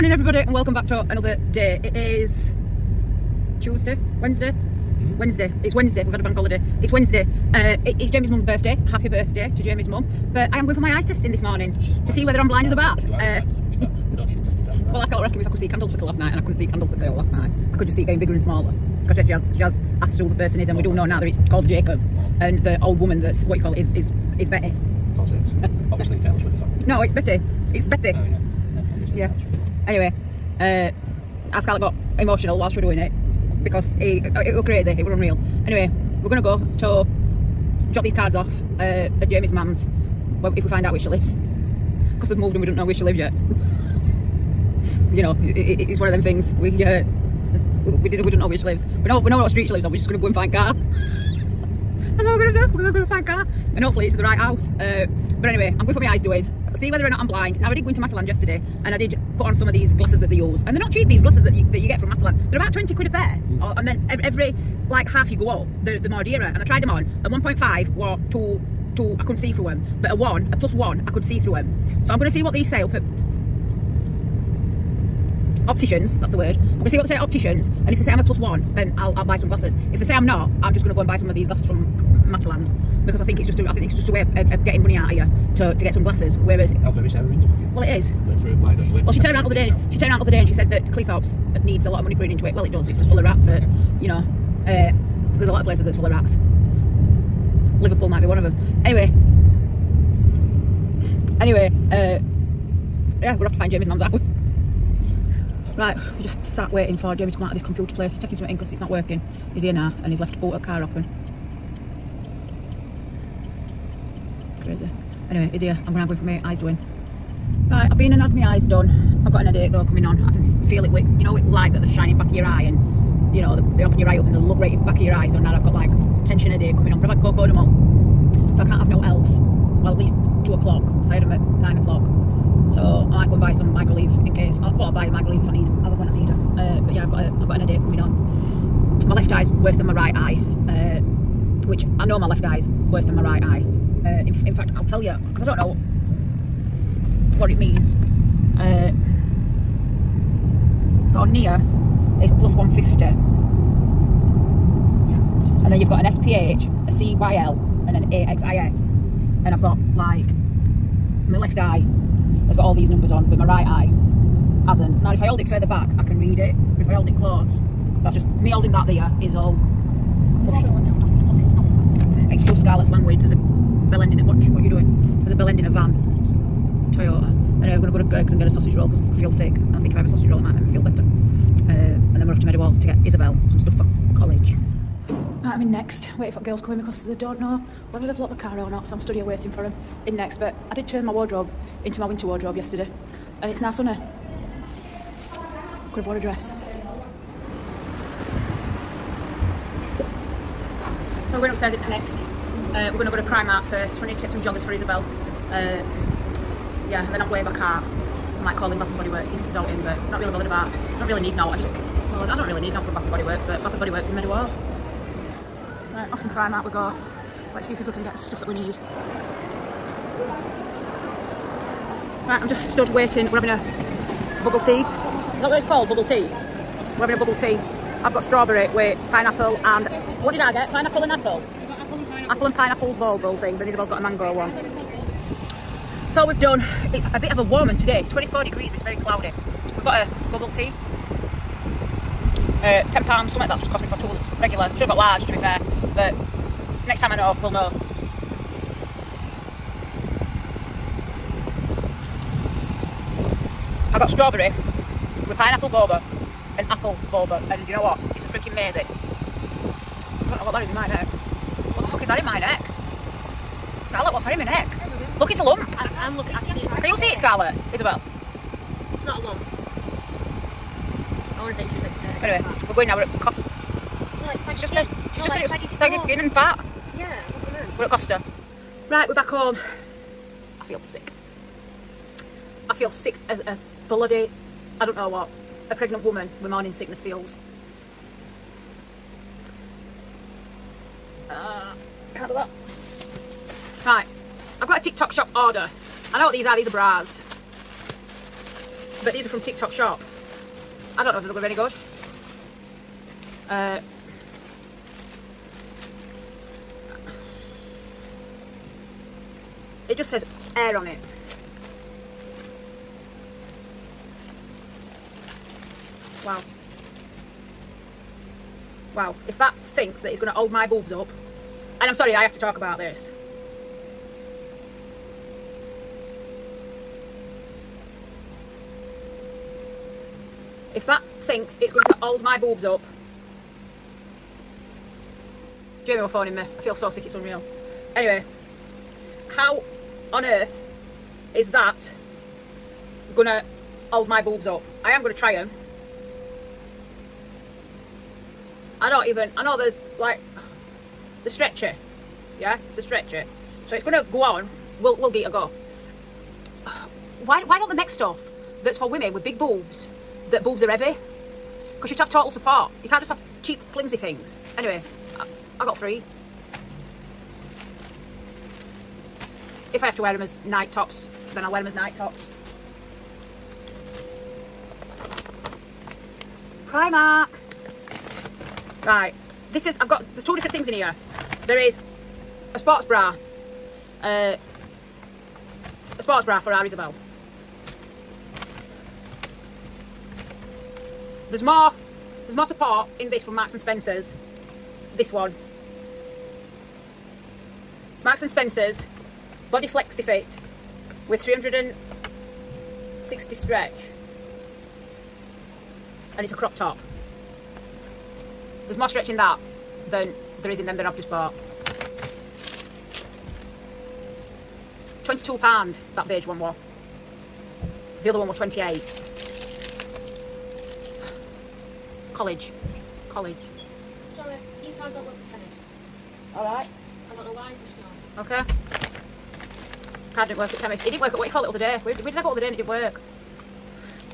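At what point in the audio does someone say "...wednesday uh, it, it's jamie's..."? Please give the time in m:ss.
0:06.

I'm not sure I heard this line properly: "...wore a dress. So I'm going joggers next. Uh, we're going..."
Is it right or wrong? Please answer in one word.
wrong.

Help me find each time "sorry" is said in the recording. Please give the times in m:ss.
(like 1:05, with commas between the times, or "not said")
5:21, 7:04.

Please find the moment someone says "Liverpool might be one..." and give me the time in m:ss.
1:37.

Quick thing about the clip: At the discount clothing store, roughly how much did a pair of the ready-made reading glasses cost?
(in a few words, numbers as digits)
20 quid.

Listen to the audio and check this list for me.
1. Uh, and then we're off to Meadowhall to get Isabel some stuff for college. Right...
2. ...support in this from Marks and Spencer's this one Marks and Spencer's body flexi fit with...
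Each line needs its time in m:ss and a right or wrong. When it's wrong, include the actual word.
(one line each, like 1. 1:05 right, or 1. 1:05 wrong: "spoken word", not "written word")
1. 3:01 right
2. 6:32 right.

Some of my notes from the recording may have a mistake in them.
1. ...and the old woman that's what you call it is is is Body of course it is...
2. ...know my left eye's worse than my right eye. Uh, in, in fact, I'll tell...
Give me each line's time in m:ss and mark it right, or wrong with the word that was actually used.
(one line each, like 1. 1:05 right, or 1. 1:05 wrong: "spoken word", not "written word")
1. 0:22 wrong: "Betty", not "Body"
2. 2:22 right.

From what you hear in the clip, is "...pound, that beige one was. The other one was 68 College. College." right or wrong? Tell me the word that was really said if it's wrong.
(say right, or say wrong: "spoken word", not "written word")
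wrong: "28", not "68".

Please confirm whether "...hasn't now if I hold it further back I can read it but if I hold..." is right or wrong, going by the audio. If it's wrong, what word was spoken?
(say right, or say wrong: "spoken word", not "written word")
right.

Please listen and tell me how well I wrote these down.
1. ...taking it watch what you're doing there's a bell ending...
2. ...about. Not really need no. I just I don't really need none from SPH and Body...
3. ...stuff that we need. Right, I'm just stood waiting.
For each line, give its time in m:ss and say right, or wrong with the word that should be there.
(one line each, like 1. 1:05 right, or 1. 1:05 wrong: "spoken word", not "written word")
1. 2:54 wrong: "ending", not "taking"
2. 3:30 wrong: "Bath", not "SPH"
3. 3:38 right.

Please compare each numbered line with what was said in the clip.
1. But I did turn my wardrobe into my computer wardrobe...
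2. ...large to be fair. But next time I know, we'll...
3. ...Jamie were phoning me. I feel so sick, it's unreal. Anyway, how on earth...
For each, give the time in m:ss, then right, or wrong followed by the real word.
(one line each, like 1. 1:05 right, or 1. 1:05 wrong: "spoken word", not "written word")
1. 3:10 wrong: "winter", not "computer"
2. 4:04 right
3. 5:35 right.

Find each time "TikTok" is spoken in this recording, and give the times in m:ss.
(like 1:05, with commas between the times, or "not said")
4:54, 4:59.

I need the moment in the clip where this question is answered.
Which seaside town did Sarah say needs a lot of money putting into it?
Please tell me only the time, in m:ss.
1:30.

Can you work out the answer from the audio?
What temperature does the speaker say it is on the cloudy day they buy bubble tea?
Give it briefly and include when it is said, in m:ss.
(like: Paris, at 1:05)
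24 degrees, at 3:58.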